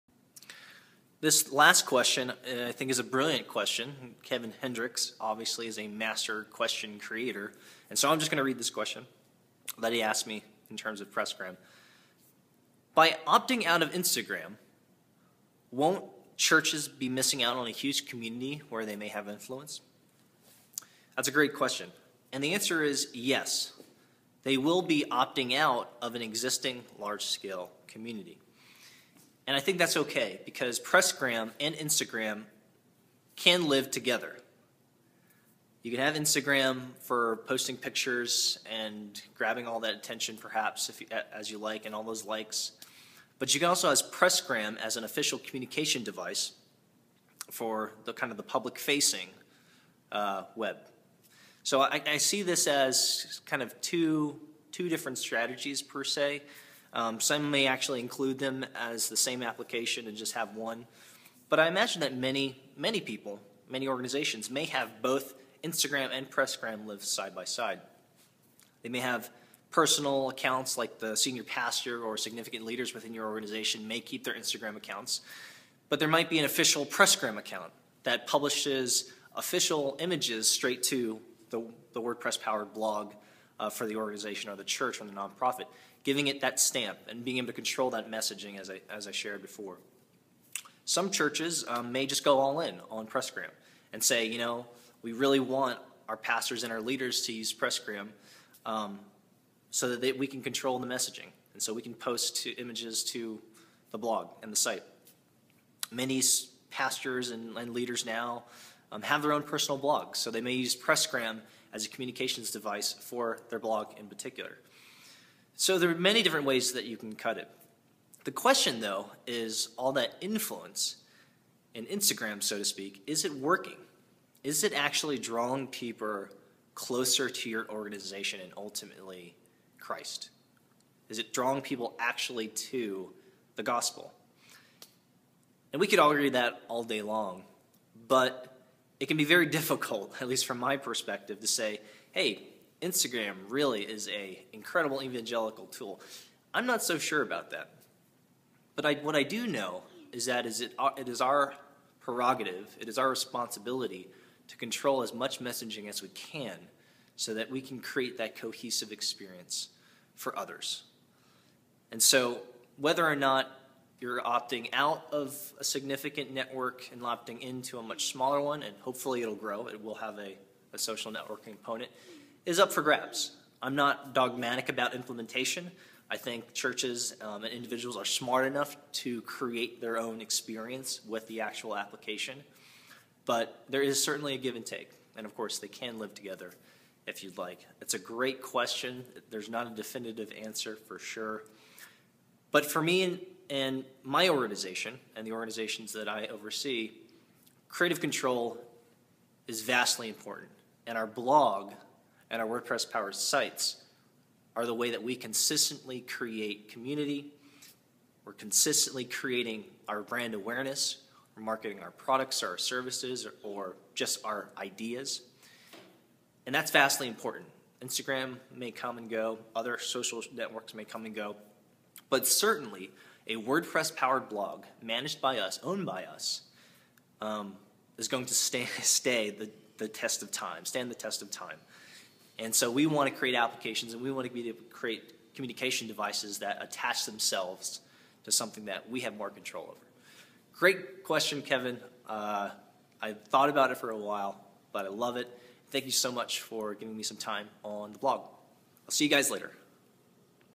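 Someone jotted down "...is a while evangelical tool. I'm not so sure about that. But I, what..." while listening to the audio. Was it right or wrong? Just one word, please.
wrong.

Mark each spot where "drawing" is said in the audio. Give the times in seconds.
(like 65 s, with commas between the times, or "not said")
125 s, 131 s.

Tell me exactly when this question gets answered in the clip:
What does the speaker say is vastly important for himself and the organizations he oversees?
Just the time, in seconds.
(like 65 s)
197 s.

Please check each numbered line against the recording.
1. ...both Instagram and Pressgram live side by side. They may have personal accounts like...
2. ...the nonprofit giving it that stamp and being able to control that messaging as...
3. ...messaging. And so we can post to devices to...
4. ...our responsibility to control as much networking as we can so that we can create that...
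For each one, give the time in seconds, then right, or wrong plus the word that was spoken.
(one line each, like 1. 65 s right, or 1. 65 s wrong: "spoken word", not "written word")
1. 65 s right
2. 85 s right
3. 100 s wrong: "images", not "devices"
4. 152 s wrong: "messaging", not "networking".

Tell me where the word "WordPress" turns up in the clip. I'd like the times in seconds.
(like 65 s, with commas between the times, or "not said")
82 s, 202 s, 223 s.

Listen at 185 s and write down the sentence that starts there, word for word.
And of course, they can live together if you'd like.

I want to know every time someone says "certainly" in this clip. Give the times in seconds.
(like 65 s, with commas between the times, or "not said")
184 s, 222 s.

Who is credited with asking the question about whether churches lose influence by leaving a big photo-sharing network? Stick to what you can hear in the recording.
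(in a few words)
Kevin Hendricks.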